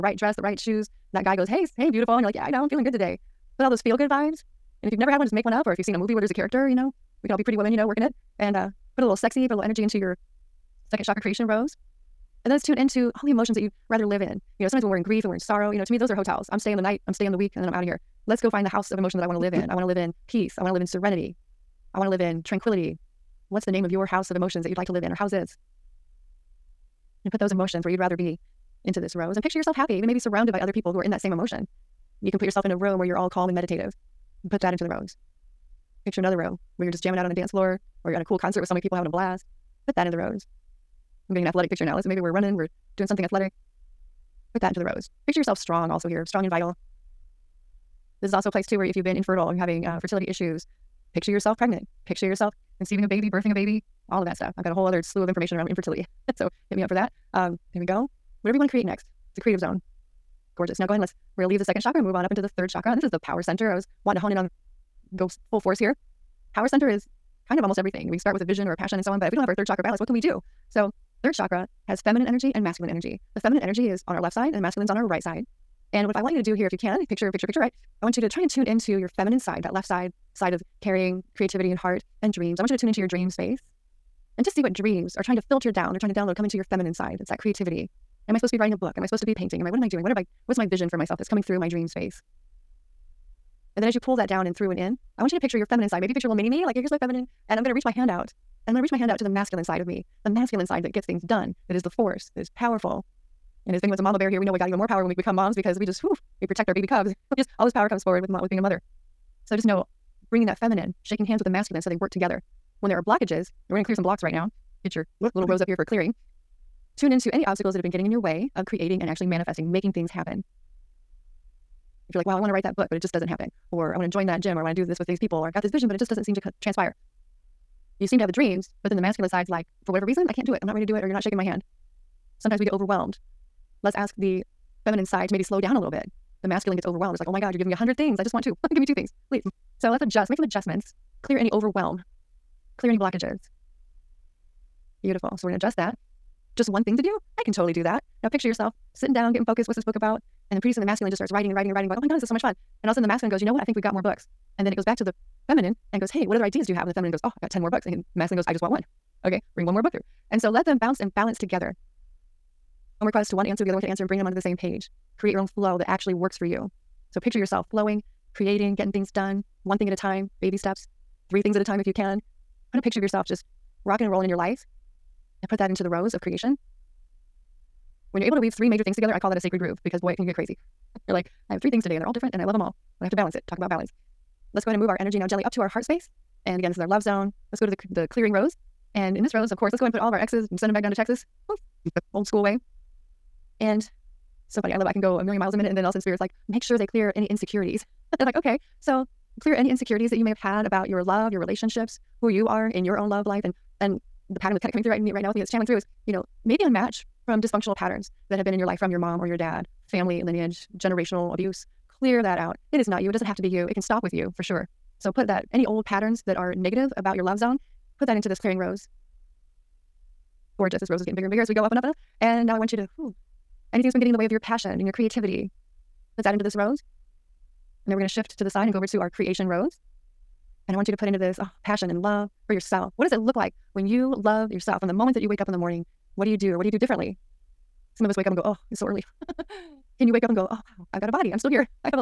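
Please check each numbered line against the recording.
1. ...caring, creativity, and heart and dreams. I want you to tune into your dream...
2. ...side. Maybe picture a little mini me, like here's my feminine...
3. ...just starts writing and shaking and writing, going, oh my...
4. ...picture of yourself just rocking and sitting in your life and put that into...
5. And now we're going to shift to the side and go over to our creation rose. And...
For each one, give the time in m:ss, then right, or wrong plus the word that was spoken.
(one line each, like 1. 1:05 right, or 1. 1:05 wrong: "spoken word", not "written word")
1. 1:20 right
2. 1:35 right
3. 2:31 wrong: "writing", not "shaking"
4. 2:52 wrong: "rolling", not "sitting"
5. 3:47 right.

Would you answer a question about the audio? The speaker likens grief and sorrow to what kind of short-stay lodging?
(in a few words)
hotels.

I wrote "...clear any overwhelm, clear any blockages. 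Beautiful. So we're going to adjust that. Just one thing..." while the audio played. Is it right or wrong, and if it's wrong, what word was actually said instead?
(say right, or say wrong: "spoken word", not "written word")
right.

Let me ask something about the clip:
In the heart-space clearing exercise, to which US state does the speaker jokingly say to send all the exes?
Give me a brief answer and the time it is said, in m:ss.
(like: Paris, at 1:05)
Texas, at 3:10.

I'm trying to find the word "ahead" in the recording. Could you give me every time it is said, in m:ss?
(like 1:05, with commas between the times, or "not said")
1:00, 3:04, 3:09.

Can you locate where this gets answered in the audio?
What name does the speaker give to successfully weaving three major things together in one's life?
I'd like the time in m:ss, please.
2:59.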